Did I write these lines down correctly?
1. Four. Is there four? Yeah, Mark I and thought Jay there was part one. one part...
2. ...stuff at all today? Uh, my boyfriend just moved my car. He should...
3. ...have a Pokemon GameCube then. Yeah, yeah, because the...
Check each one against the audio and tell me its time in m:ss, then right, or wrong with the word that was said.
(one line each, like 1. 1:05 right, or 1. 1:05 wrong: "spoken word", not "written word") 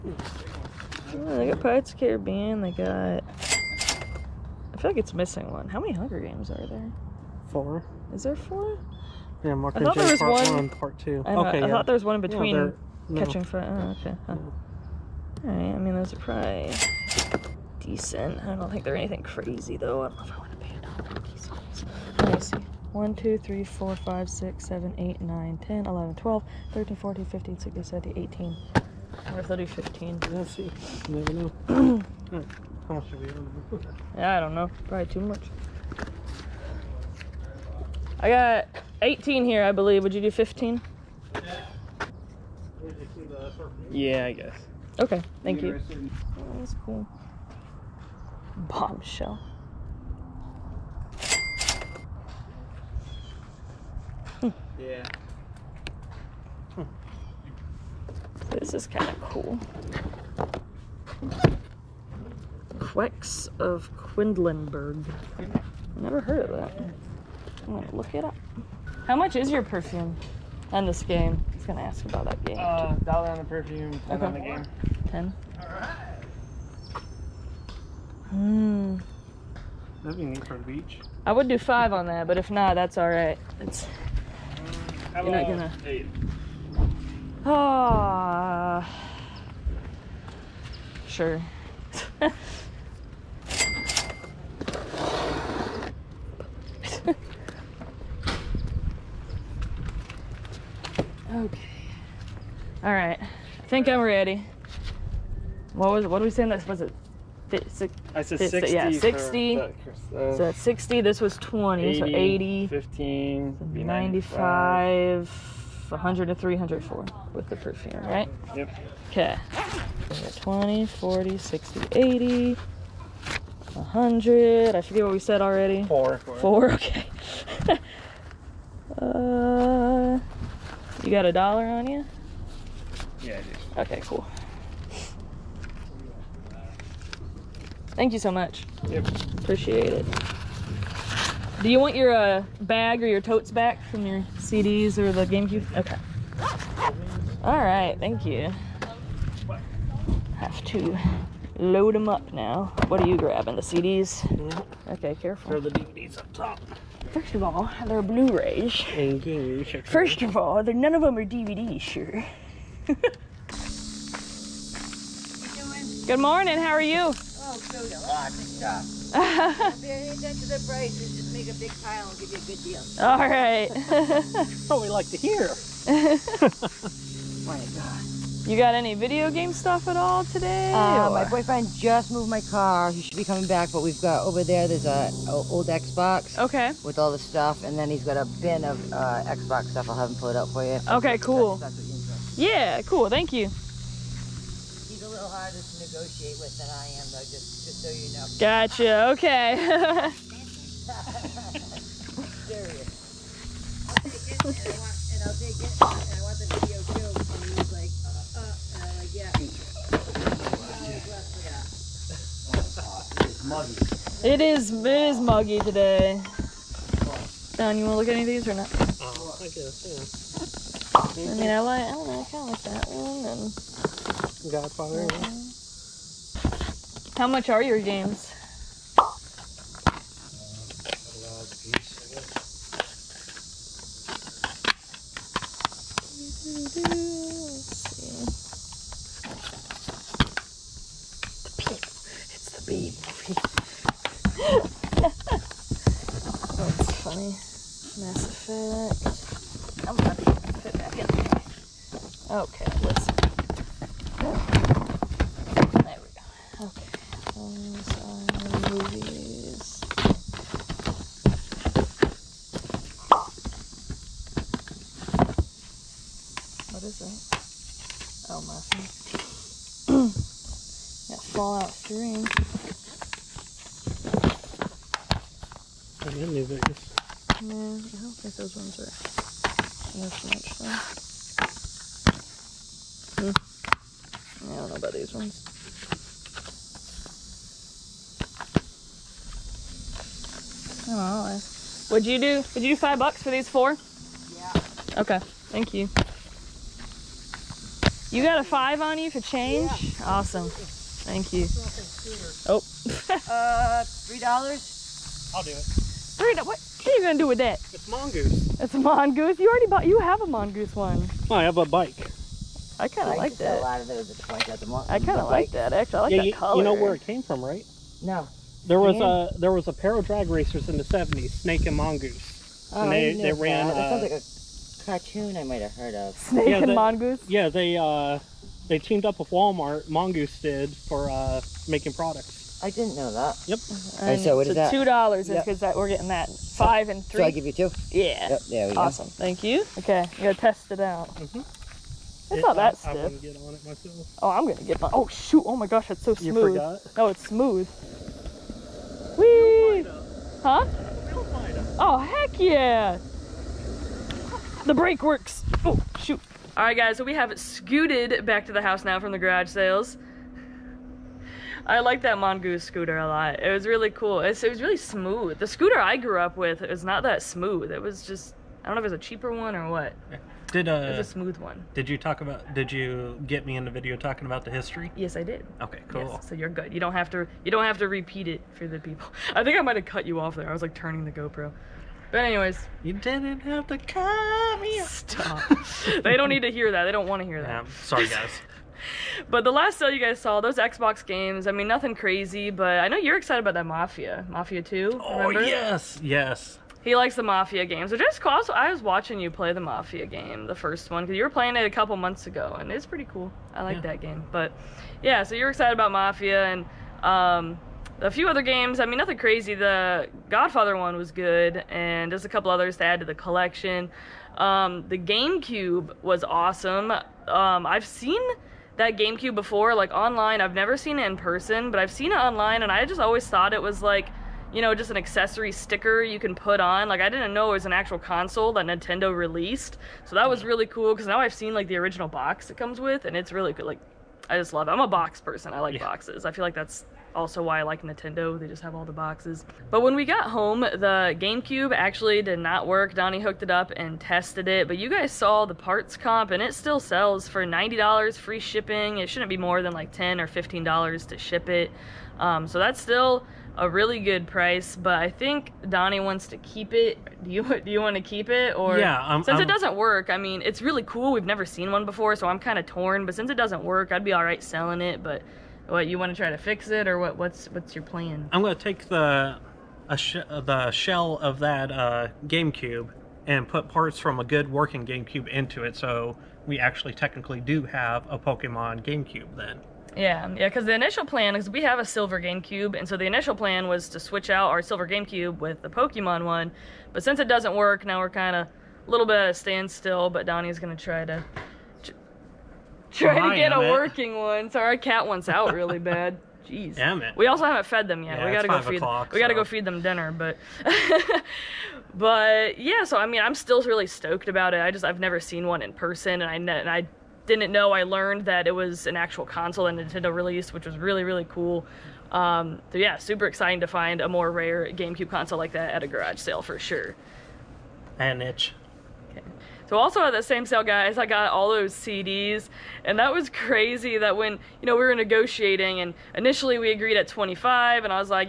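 1. 0:07 right
2. 2:59 right
3. 7:57 right.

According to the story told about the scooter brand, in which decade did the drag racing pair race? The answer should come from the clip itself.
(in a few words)
1970s.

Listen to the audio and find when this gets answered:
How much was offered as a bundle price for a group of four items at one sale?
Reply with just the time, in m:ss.
4:52.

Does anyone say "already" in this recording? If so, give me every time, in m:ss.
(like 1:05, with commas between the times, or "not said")
2:05, 5:09.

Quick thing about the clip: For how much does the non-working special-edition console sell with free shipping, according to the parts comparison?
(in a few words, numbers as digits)
$90.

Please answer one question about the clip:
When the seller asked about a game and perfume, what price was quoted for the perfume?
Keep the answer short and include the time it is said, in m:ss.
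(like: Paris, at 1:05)
$1, at 1:13.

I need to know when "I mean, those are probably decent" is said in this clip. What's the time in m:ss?
0:15.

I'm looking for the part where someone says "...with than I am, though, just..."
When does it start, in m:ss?
3:16.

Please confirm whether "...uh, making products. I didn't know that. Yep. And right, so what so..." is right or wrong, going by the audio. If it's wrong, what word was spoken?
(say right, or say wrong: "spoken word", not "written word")
right.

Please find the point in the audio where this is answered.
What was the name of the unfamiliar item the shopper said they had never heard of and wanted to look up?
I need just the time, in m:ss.
1:02.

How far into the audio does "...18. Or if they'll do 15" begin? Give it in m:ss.
0:28.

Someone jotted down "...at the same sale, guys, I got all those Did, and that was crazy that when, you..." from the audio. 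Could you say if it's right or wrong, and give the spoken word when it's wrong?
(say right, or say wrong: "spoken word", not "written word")
wrong: "CDs", not "Did".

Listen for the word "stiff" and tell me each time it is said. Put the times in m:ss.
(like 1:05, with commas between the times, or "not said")
5:42.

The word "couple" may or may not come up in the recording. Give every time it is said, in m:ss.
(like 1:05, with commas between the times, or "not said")
6:41, 6:52.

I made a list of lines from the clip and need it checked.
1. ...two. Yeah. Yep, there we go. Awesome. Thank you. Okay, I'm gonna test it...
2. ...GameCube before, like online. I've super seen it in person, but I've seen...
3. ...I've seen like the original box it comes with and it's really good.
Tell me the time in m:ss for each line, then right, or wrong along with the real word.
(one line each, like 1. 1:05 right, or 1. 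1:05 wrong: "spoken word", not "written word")
1. 5:37 right
2. 6:58 wrong: "never", not "super"
3. 7:11 right.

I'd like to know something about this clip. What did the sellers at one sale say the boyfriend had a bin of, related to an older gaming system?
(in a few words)
Xbox stuff.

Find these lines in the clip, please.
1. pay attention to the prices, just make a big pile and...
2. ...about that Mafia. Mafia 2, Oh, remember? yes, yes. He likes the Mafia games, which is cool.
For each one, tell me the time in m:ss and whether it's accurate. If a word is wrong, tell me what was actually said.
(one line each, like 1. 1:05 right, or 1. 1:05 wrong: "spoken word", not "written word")
1. 2:49 right
2. 6:33 right.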